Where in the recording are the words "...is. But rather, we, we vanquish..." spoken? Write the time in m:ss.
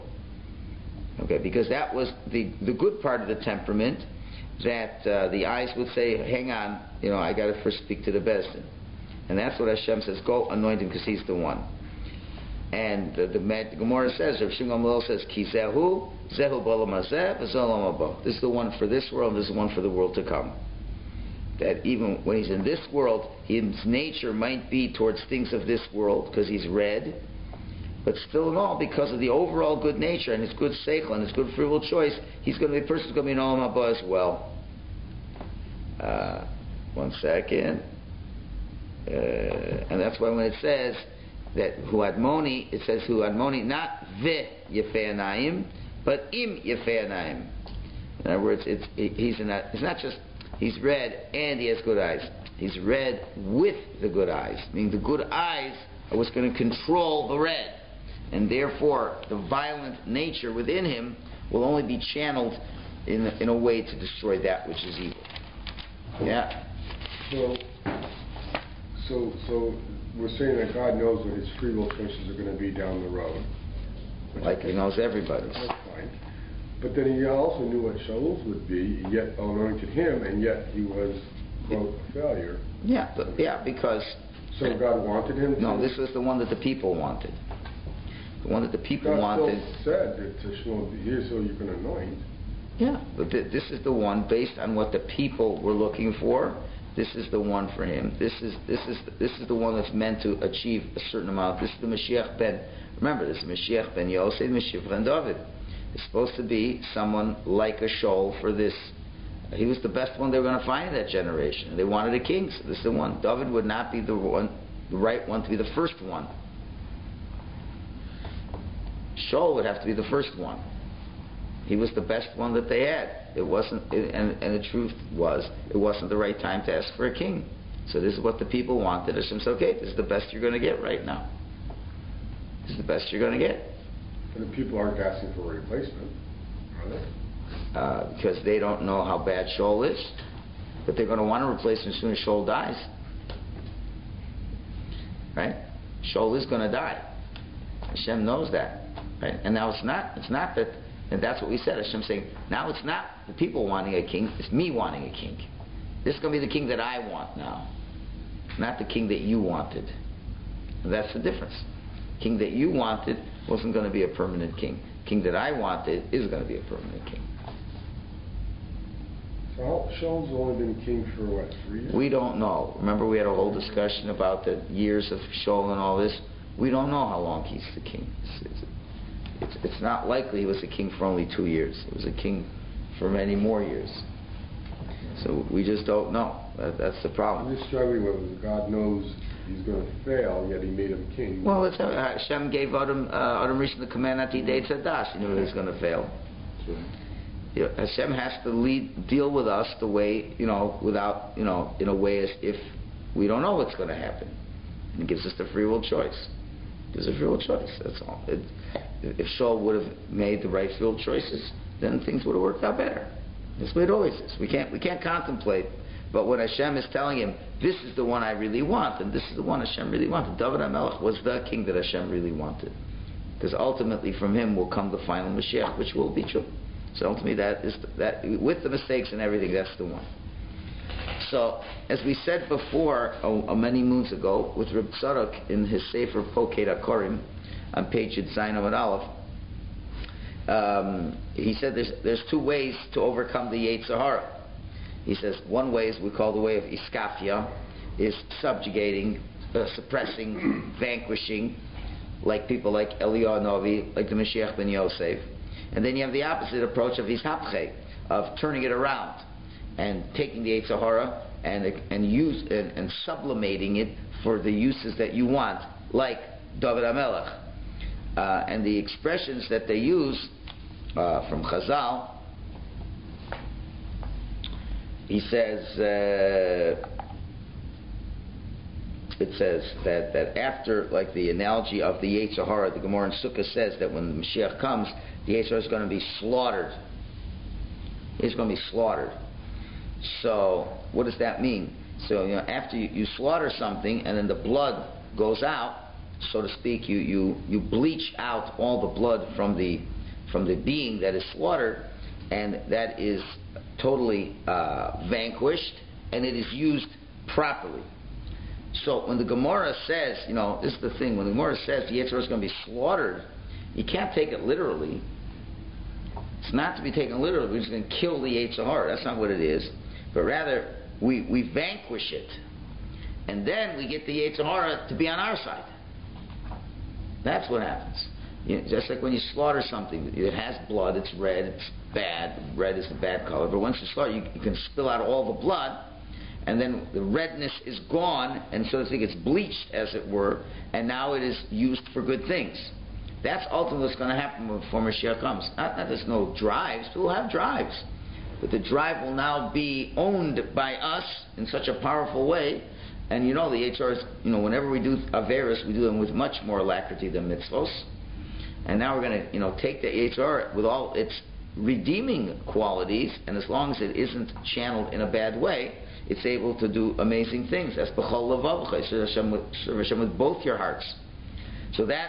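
5:19.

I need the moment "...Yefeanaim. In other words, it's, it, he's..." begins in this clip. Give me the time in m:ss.
0:46.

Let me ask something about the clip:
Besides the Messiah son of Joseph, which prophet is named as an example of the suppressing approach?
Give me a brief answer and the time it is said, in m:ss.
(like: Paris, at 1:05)
Eliyahu, at 4:12.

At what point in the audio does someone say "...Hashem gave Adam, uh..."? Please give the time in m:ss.
3:11.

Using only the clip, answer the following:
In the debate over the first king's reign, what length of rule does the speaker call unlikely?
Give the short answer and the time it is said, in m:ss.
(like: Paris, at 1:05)
2, at 3:01.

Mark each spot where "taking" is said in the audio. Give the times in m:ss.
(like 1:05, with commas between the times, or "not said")
4:20.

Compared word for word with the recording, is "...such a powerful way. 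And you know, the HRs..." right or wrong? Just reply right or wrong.
right.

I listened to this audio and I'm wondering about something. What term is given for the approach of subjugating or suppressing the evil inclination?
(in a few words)
Iskafia.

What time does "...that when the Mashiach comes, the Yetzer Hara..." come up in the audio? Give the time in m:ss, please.
4:43.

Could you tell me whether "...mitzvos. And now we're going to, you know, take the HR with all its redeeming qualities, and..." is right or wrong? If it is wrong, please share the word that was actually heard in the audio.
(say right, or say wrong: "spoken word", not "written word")
right.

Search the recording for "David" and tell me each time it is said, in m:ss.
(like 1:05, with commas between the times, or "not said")
1:45, 1:53, 3:40, 4:26.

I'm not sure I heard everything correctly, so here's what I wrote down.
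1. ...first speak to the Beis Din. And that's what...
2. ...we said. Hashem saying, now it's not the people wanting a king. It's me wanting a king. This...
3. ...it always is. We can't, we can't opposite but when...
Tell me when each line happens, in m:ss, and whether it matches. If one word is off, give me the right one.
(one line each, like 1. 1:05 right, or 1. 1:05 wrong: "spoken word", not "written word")
1. 0:07 right
2. 2:31 right
3. 3:33 wrong: "contemplate", not "opposite".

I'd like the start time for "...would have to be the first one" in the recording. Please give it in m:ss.
1:59.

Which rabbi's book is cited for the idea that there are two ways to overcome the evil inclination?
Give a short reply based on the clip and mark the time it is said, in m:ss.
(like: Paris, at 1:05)
Reb Tzadok, at 3:54.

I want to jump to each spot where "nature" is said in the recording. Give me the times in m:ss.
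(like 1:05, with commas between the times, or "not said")
0:23, 0:29, 1:00.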